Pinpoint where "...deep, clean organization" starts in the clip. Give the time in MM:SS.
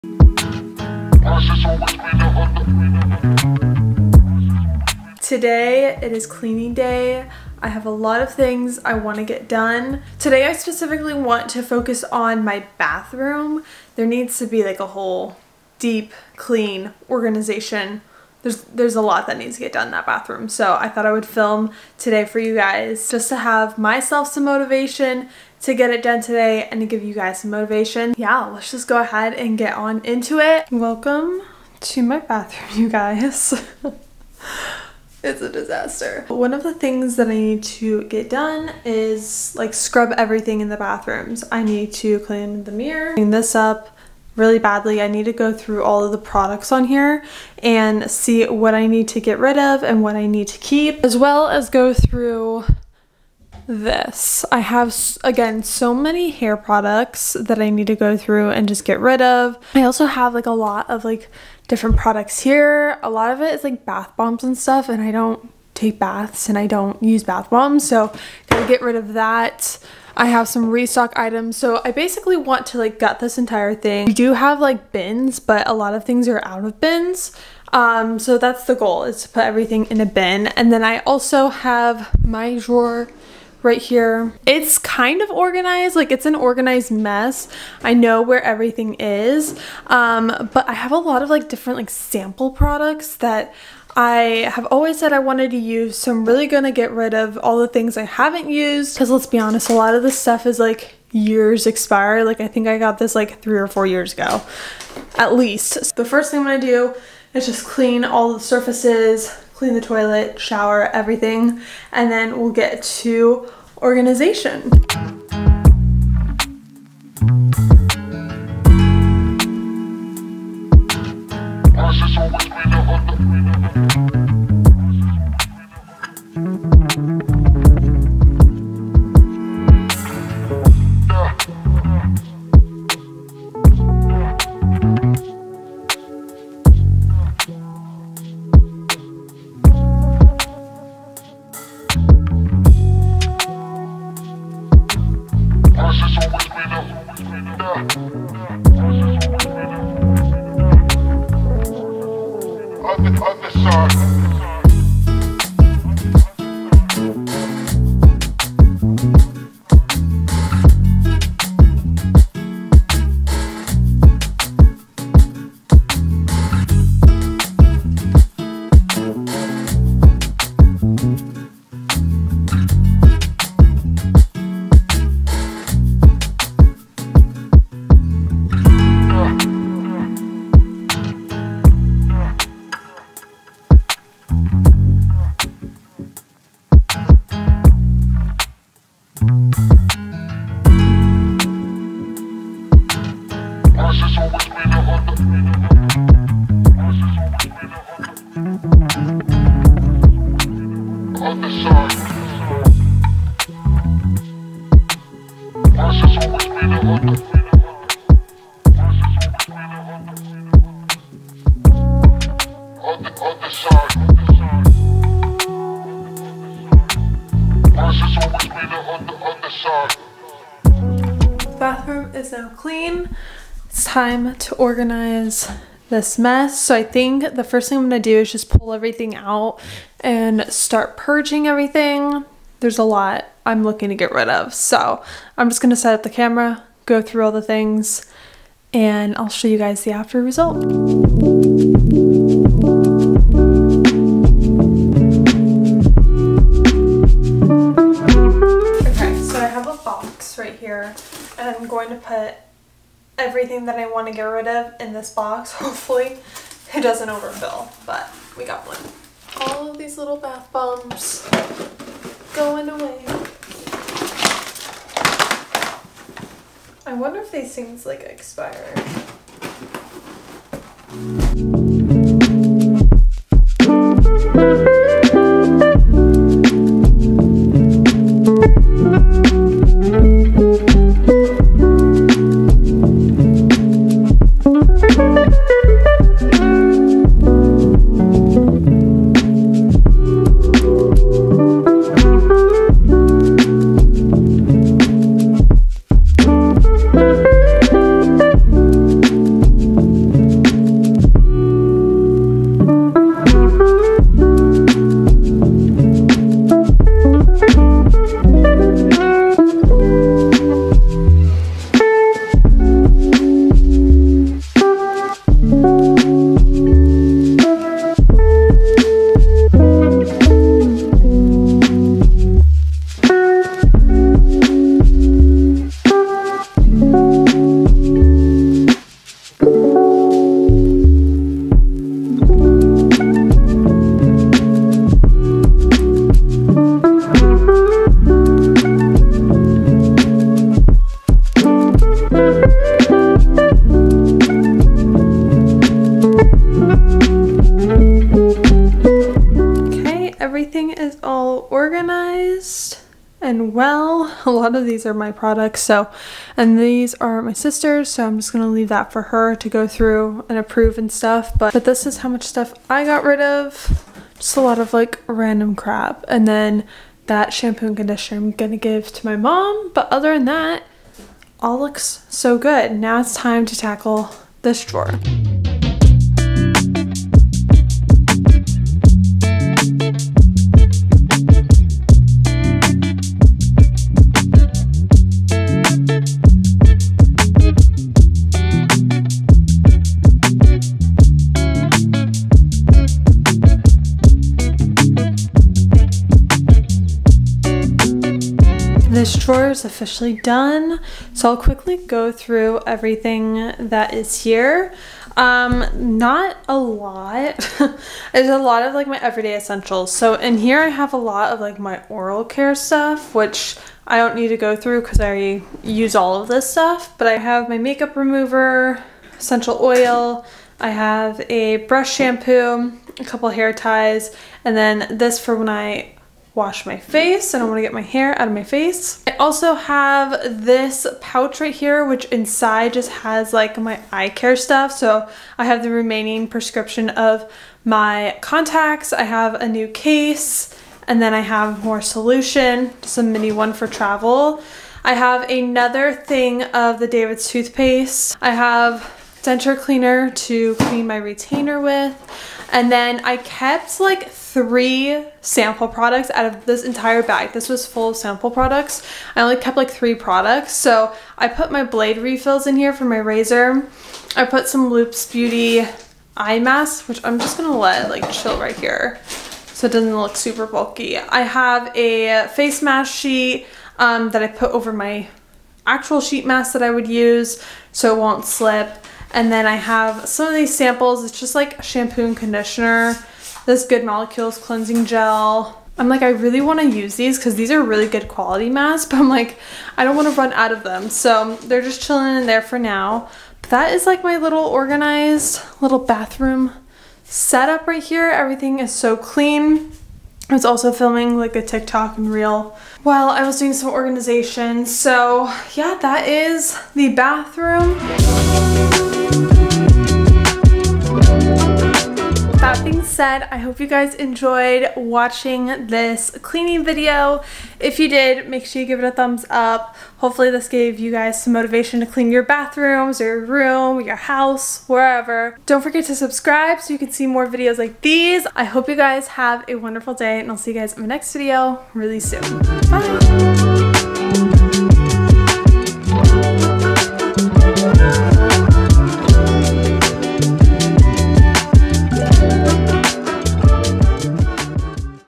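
00:15.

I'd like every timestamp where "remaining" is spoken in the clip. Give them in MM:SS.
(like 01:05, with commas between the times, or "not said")
07:15.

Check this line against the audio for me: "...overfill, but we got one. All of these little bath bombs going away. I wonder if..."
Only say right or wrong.
right.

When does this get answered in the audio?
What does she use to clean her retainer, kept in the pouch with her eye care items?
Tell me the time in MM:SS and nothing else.
07:29.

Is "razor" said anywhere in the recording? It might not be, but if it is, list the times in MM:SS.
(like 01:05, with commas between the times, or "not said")
07:42.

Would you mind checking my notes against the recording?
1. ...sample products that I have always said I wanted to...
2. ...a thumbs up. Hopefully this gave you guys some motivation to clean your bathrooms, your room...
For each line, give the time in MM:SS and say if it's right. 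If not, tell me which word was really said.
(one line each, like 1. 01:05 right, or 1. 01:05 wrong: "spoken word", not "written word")
1. 01:31 right
2. 08:38 right.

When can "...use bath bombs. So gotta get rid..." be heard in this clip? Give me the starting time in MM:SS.
01:07.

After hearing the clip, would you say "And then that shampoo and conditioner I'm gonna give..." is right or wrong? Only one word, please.
right.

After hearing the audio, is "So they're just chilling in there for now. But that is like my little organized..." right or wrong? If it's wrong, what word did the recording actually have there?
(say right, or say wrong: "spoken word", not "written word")
right.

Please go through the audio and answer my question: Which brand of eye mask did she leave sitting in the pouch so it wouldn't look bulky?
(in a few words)
Loops Beauty.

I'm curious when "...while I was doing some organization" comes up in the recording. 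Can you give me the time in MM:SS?
08:22.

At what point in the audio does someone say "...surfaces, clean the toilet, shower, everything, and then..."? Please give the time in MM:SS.
01:48.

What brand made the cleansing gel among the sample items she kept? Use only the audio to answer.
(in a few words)
Good Molecules.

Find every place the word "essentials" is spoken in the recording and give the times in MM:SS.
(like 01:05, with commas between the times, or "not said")
06:49, 06:59.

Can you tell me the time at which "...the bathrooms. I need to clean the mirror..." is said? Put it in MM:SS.
00:40.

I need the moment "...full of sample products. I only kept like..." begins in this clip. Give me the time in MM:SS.
07:37.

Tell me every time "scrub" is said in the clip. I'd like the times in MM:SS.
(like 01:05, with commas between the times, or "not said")
00:39.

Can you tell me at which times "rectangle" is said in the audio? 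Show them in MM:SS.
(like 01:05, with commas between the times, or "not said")
not said.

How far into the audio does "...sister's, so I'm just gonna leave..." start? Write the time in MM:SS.
05:57.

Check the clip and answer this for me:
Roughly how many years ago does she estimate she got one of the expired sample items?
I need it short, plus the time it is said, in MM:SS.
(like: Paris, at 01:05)
3 or 4 years, at 01:43.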